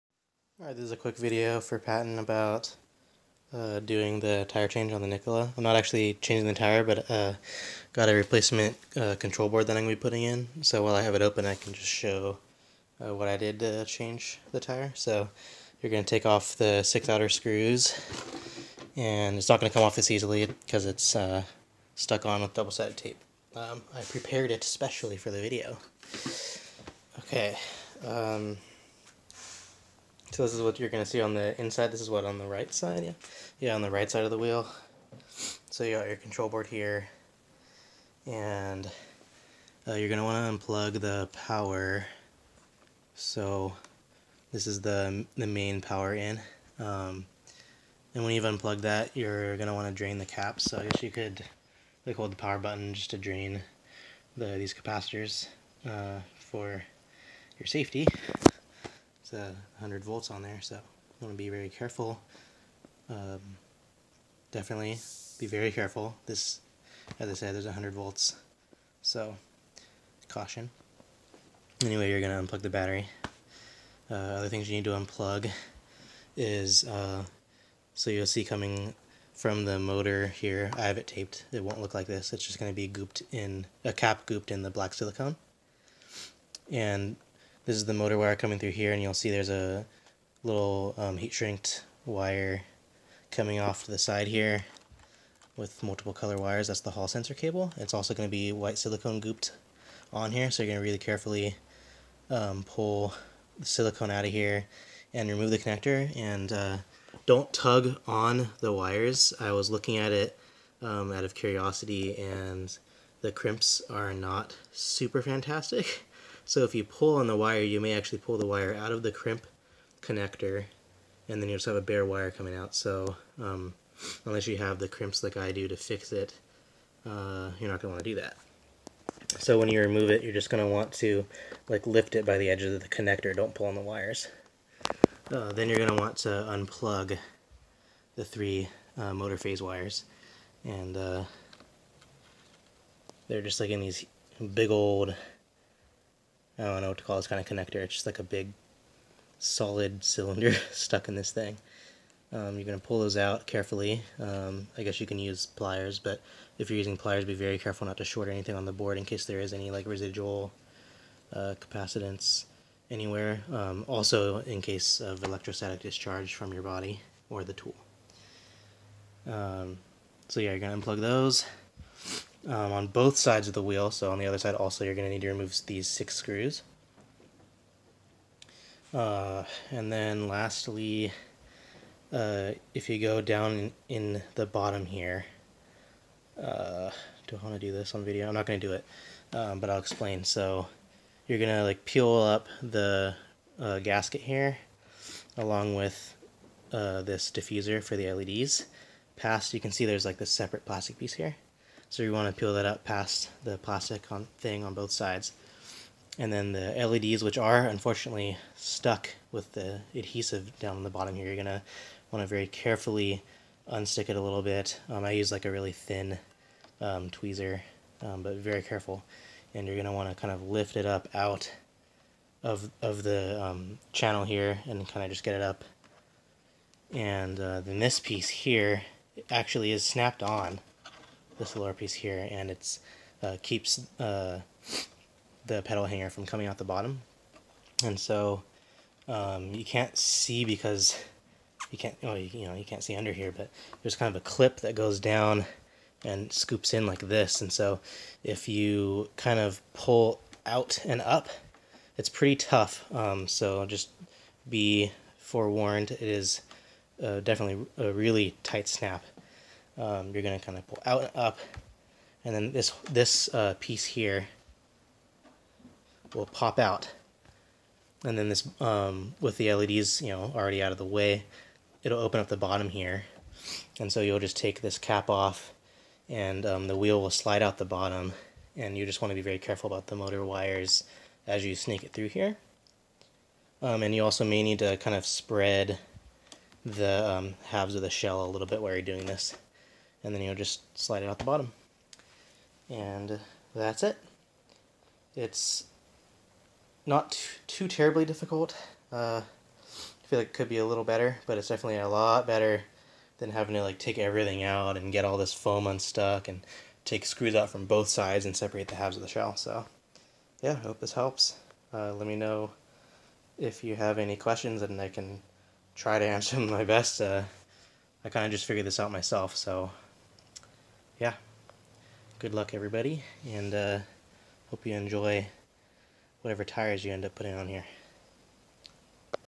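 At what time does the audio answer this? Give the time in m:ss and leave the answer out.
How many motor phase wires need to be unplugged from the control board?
2:18.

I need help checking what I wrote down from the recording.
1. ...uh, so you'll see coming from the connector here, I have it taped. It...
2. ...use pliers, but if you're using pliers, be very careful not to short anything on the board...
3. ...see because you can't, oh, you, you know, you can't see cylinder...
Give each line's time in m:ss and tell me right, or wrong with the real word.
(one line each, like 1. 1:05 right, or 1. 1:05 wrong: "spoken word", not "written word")
1. 1:16 wrong: "motor", not "connector"
2. 2:35 right
3. 3:59 wrong: "under", not "cylinder".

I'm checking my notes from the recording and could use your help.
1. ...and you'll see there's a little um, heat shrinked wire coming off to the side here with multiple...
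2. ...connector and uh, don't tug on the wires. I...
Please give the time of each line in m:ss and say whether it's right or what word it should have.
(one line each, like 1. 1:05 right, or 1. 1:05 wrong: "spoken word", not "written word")
1. 1:28 right
2. 1:45 right.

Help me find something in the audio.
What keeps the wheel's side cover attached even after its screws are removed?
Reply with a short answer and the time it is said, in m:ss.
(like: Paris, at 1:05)
double-sided tape, at 0:22.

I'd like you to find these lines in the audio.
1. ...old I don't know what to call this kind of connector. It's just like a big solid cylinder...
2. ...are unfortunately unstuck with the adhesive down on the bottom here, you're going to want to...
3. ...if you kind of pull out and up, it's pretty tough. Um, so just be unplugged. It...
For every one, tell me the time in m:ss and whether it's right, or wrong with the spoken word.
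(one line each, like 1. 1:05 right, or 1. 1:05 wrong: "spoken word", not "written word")
1. 2:24 right
2. 3:27 wrong: "stuck", not "unstuck"
3. 4:08 wrong: "forewarned", not "unplugged".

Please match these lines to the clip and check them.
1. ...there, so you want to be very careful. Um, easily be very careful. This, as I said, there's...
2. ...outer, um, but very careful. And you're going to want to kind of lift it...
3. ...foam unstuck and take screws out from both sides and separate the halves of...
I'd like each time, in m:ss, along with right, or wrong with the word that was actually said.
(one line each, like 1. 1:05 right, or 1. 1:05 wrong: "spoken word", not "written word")
1. 1:00 wrong: "definitely", not "easily"
2. 3:37 wrong: "tweezer", not "outer"
3. 5:05 right.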